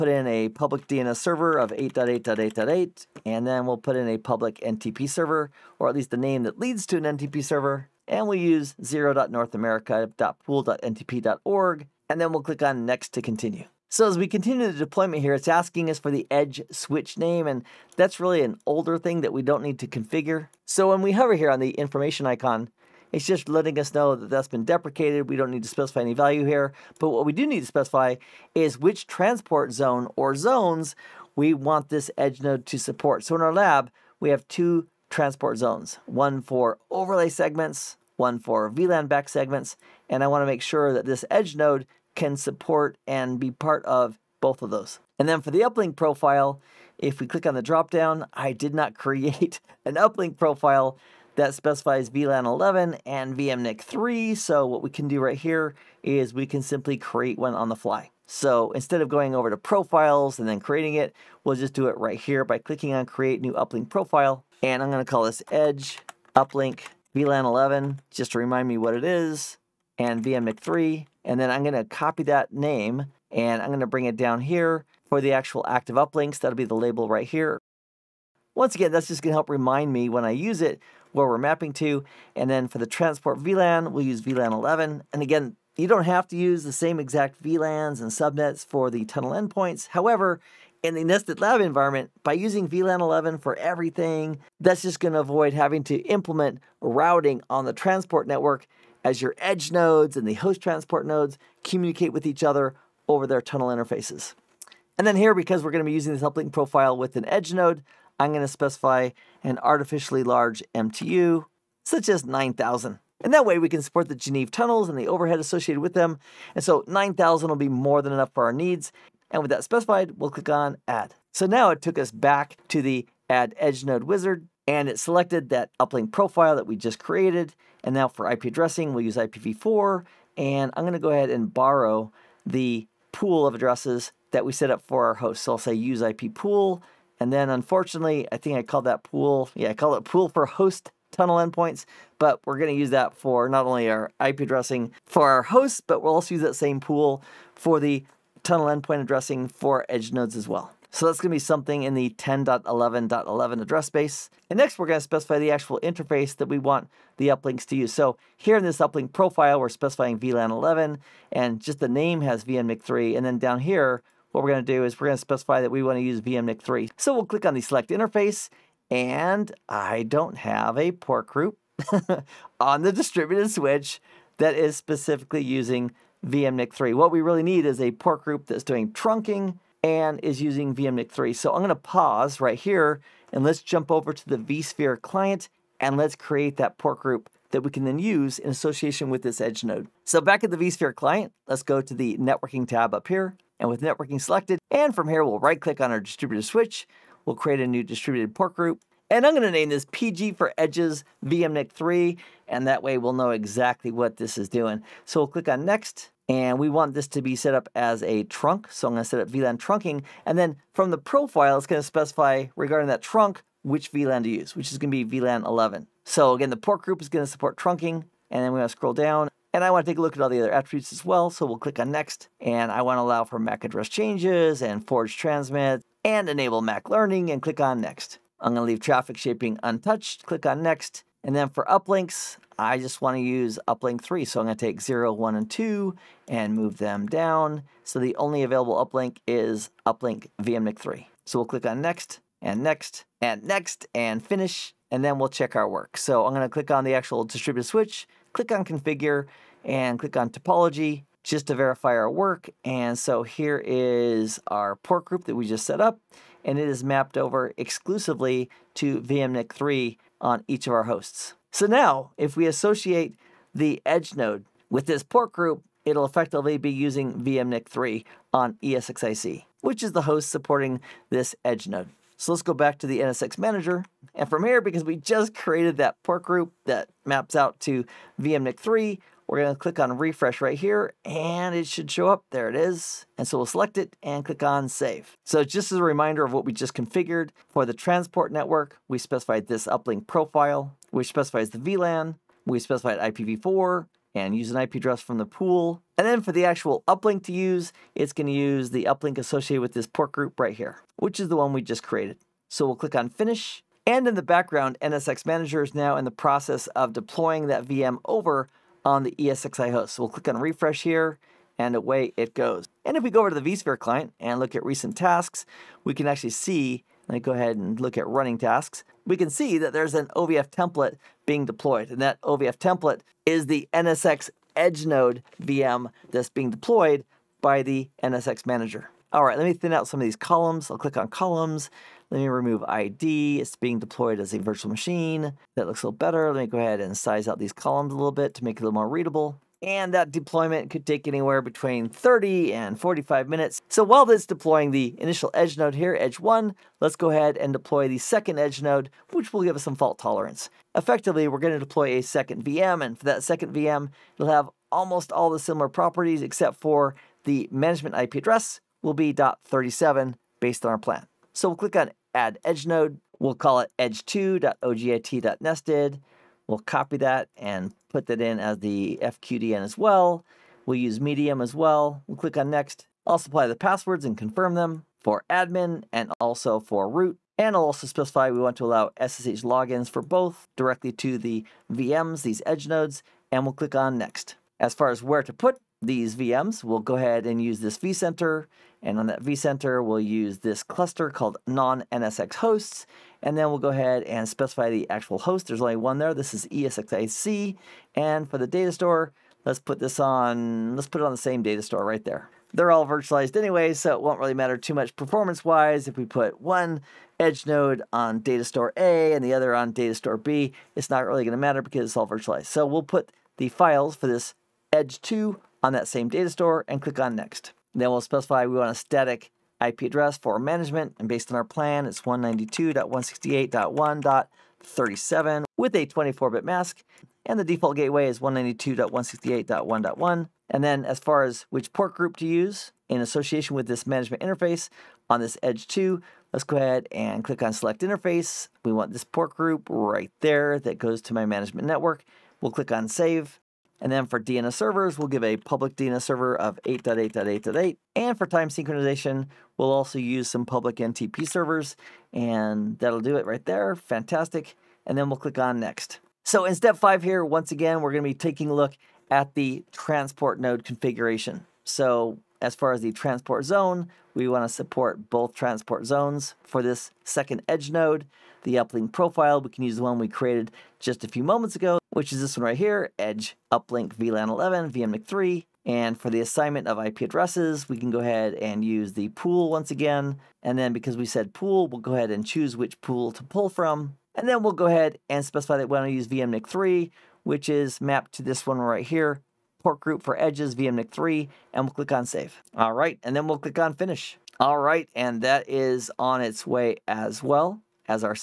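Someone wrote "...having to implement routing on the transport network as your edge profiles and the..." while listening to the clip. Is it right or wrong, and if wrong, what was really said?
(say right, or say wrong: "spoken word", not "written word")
wrong: "nodes", not "profiles".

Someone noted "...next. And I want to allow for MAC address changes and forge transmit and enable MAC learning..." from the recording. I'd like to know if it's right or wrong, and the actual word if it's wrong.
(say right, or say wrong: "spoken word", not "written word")
right.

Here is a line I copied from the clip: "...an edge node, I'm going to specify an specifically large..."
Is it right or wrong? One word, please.
wrong.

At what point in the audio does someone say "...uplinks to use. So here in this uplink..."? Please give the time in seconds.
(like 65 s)
157 s.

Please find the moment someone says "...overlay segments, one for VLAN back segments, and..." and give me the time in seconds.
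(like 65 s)
36 s.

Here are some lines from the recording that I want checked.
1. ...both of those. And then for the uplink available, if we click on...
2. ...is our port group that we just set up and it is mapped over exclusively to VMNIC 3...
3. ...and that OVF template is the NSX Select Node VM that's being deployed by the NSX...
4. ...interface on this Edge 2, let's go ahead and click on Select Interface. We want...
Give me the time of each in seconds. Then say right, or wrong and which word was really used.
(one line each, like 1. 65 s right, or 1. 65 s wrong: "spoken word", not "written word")
1. 44 s wrong: "profile", not "available"
2. 253 s right
3. 321 s wrong: "Edge", not "Select"
4. 434 s right.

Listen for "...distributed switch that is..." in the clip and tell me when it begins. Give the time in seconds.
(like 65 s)
172 s.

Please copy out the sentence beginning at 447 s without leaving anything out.
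And for time synchronization, we'll also use some public NTP servers.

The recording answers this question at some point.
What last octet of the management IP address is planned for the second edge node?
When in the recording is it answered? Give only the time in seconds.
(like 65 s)
359 s.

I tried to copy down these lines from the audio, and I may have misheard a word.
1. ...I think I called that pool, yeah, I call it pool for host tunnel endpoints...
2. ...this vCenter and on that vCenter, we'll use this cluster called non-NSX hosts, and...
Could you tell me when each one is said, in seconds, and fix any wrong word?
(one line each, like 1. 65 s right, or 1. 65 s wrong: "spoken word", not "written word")
1. 138 s right
2. 387 s right.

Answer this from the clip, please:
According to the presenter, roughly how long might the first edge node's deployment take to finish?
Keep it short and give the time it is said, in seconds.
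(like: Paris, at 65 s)
30 to 45 minutes, at 341 s.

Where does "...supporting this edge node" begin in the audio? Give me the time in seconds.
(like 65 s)
270 s.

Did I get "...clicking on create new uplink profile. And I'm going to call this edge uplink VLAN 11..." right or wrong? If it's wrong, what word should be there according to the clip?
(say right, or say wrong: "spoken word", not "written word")
right.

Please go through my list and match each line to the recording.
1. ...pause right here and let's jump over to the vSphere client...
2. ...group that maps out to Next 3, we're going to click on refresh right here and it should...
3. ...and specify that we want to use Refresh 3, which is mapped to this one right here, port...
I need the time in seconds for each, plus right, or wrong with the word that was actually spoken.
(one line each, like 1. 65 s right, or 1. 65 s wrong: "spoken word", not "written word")
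1. 181 s right
2. 276 s wrong: "VMNIC", not "Next"
3. 485 s wrong: "VMNIC", not "Refresh".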